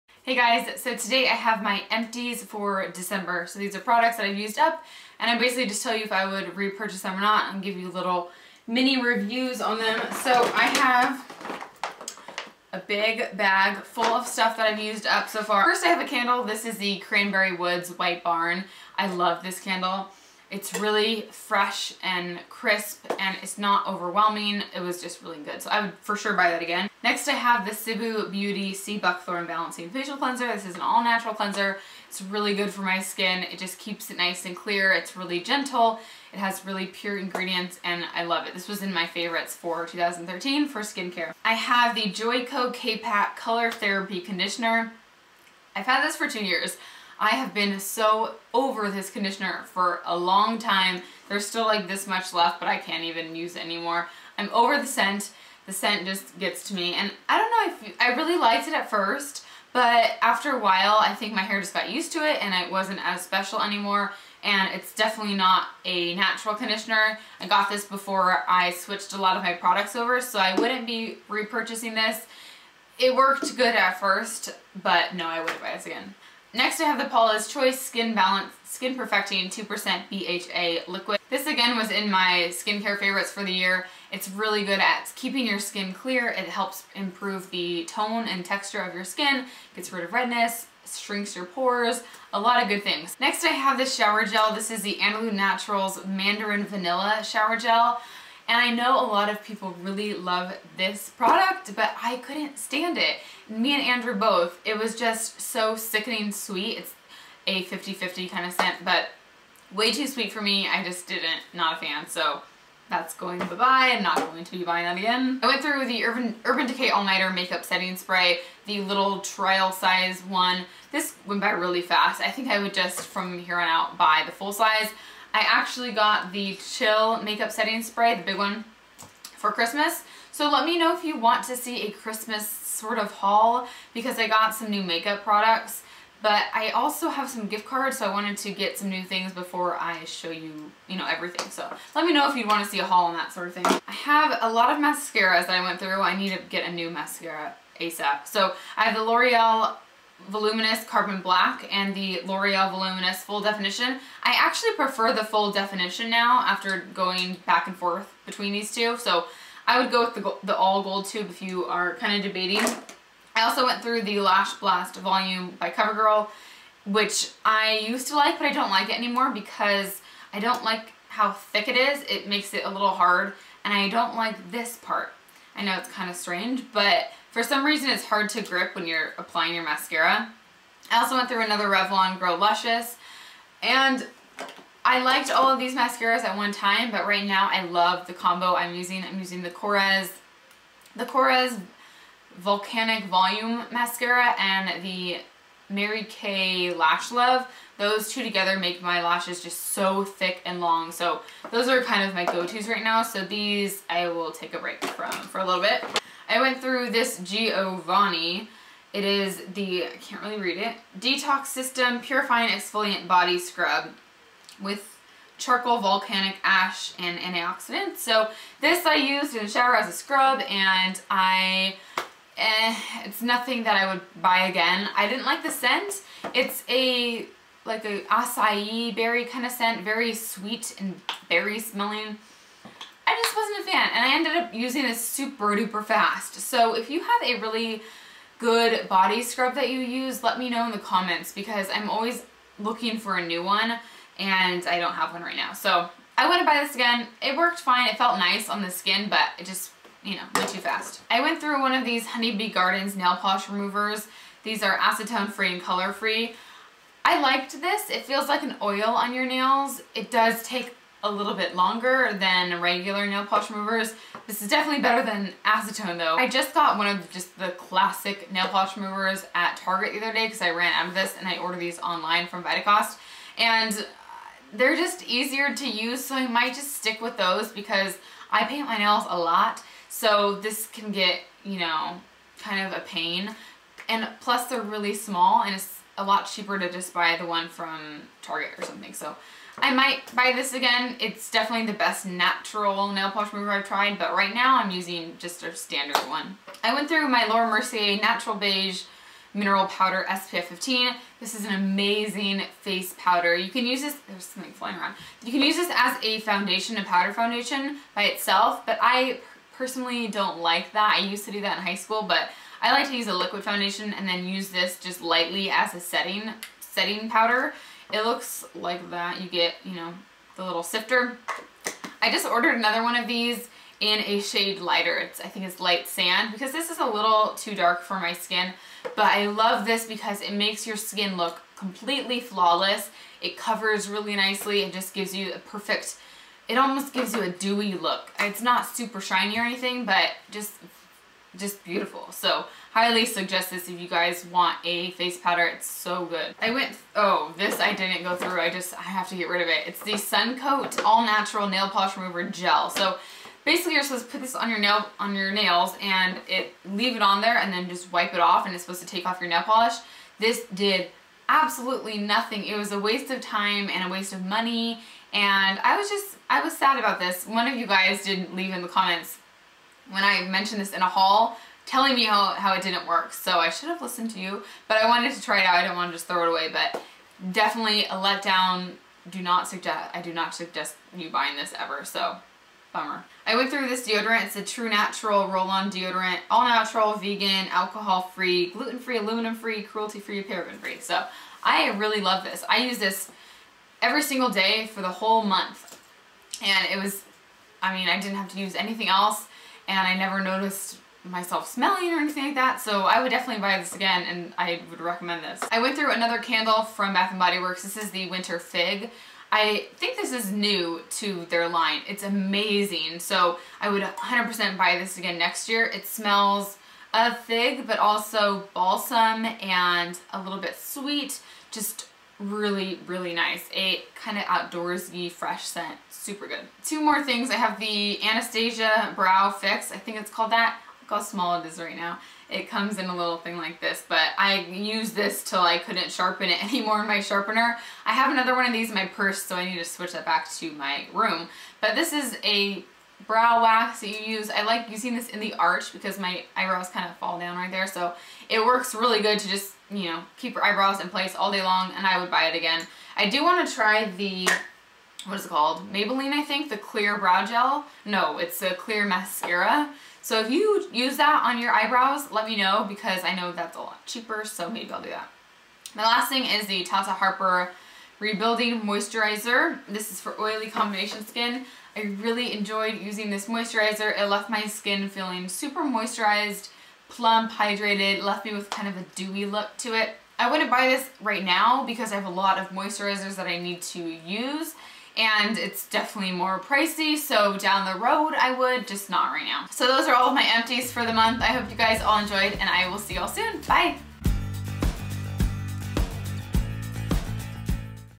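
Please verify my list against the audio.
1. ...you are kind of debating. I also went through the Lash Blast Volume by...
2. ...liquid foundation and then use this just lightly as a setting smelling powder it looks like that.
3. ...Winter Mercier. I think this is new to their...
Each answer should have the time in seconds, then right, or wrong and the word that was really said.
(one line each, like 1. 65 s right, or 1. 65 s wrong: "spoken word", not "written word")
1. 161 s right
2. 313 s wrong: "setting", not "smelling"
3. 408 s wrong: "Fig", not "Mercier".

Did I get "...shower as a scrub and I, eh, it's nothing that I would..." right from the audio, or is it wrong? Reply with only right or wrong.
right.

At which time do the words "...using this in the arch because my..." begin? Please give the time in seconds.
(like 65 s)
444 s.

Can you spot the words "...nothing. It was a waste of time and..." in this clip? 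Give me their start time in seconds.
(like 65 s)
361 s.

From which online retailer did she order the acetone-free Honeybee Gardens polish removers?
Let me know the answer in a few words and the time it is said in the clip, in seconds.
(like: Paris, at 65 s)
Vitacost, at 272 s.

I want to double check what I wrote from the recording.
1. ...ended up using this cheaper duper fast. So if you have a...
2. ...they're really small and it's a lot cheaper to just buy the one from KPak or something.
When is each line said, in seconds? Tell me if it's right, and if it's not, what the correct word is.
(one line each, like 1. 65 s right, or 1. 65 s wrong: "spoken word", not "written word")
1. 234 s wrong: "super", not "cheaper"
2. 284 s wrong: "Target", not "KPak".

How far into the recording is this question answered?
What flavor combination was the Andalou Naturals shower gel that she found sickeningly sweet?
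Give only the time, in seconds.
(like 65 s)
96 s.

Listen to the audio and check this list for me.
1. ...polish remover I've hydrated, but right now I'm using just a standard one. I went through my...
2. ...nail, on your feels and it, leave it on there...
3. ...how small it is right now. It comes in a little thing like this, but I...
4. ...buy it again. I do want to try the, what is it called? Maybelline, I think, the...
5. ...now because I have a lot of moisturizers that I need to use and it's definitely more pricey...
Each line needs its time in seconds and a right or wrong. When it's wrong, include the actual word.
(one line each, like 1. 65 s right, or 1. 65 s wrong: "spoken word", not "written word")
1. 293 s wrong: "tried", not "hydrated"
2. 354 s wrong: "nails", not "feels"
3. 430 s right
4. 452 s right
5. 481 s right.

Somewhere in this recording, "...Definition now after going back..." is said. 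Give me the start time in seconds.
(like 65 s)
155 s.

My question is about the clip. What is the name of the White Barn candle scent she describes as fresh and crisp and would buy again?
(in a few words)
Cranberry Woods.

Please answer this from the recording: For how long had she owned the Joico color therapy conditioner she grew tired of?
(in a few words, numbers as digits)
2 years.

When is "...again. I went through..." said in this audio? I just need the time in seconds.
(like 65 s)
114 s.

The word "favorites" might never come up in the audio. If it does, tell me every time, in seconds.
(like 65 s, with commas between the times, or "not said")
39 s, 82 s.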